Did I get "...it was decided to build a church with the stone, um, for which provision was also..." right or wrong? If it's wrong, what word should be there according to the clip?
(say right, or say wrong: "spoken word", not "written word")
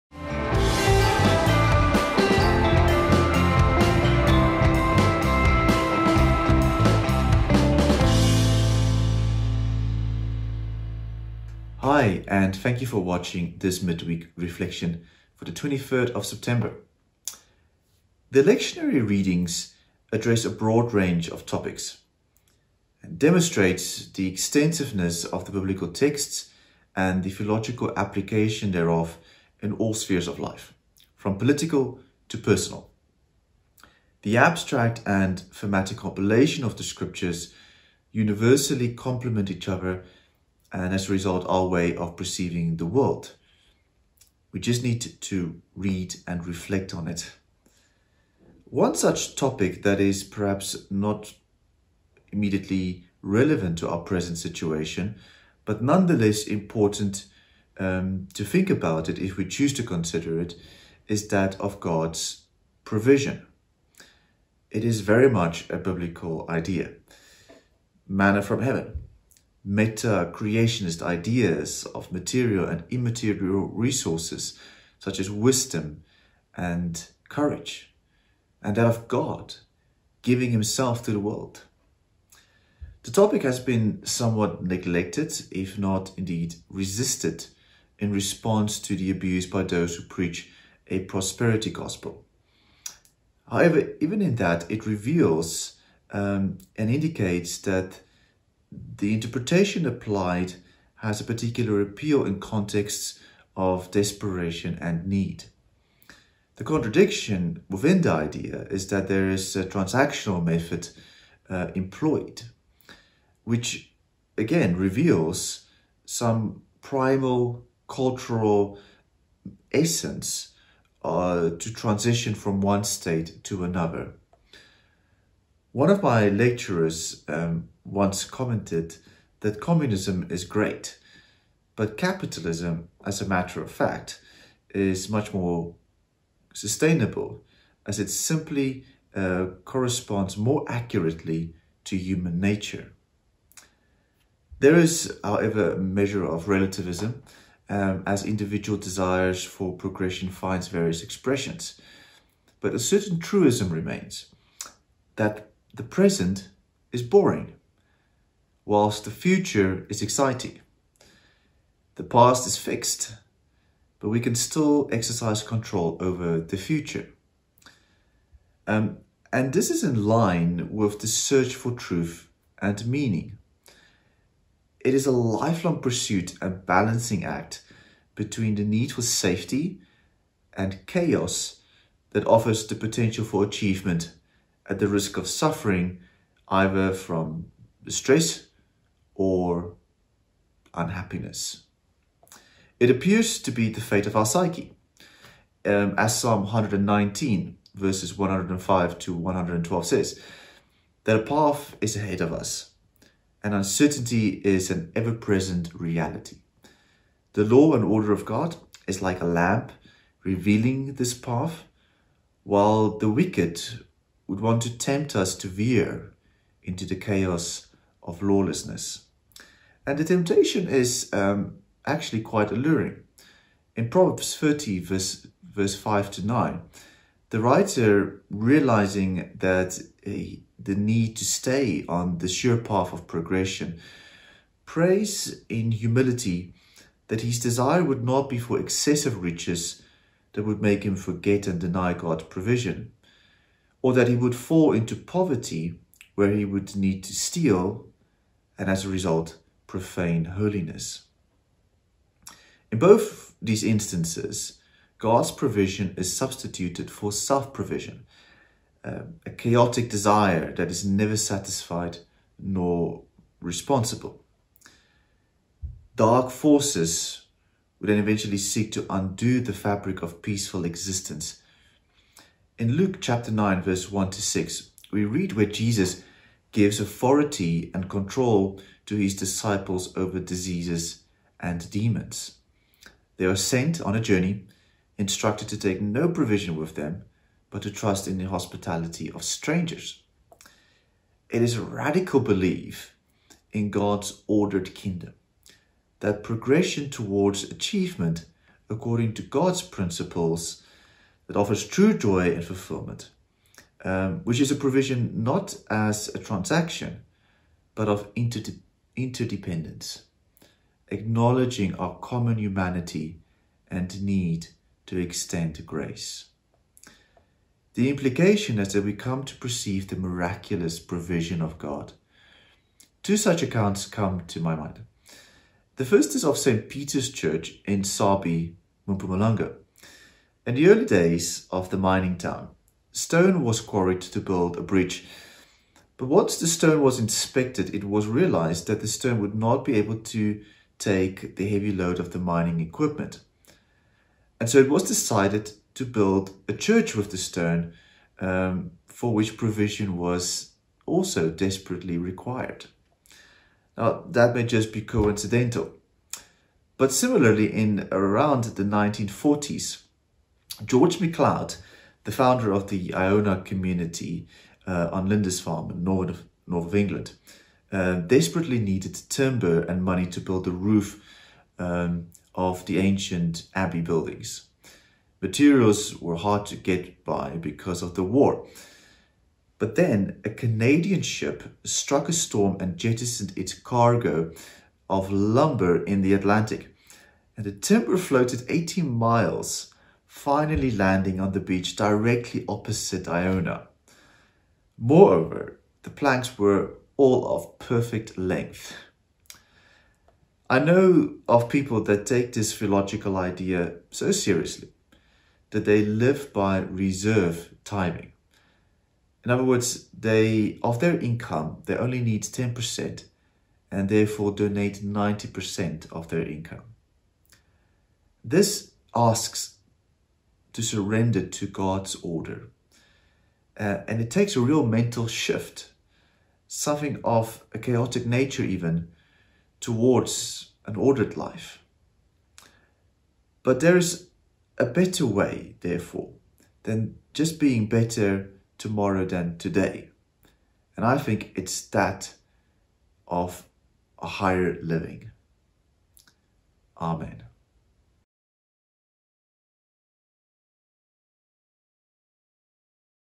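right.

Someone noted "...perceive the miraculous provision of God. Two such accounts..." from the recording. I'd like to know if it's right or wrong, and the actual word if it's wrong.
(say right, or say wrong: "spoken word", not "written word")
right.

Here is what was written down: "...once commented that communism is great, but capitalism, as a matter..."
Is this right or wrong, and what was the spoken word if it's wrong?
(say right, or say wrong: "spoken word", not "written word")
right.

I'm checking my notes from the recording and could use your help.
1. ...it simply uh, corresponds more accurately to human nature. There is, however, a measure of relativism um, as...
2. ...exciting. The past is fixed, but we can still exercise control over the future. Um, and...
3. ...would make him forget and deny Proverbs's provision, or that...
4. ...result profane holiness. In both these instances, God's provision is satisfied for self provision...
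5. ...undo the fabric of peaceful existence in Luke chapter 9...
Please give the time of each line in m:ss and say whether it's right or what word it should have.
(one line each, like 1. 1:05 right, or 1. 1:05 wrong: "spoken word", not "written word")
1. 2:18 right
2. 2:40 right
3. 4:00 wrong: "God", not "Proverbs"
4. 4:08 wrong: "substituted", not "satisfied"
5. 4:28 right.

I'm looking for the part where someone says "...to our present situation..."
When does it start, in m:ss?
0:53.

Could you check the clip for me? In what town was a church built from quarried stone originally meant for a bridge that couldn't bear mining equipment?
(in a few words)
Sabie.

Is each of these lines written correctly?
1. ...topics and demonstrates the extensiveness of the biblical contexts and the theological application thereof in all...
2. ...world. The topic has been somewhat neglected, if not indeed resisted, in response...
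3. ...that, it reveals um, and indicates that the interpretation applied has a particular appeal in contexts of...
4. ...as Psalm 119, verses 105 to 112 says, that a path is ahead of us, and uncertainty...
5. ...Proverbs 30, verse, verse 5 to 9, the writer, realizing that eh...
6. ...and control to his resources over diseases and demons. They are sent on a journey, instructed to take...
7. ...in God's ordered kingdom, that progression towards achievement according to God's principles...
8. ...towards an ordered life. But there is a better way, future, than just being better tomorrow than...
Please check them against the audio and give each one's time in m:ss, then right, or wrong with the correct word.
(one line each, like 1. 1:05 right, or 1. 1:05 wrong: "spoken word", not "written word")
1. 0:21 wrong: "texts", not "contexts"
2. 1:21 right
3. 1:34 right
4. 3:15 right
5. 3:43 right
6. 4:37 wrong: "disciples", not "resources"
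7. 4:53 right
8. 7:09 wrong: "therefore", not "future".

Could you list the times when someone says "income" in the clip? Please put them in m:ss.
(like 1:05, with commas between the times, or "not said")
6:50, 6:56.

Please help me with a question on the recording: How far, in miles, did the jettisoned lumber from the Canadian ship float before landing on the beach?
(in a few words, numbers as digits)
18 miles.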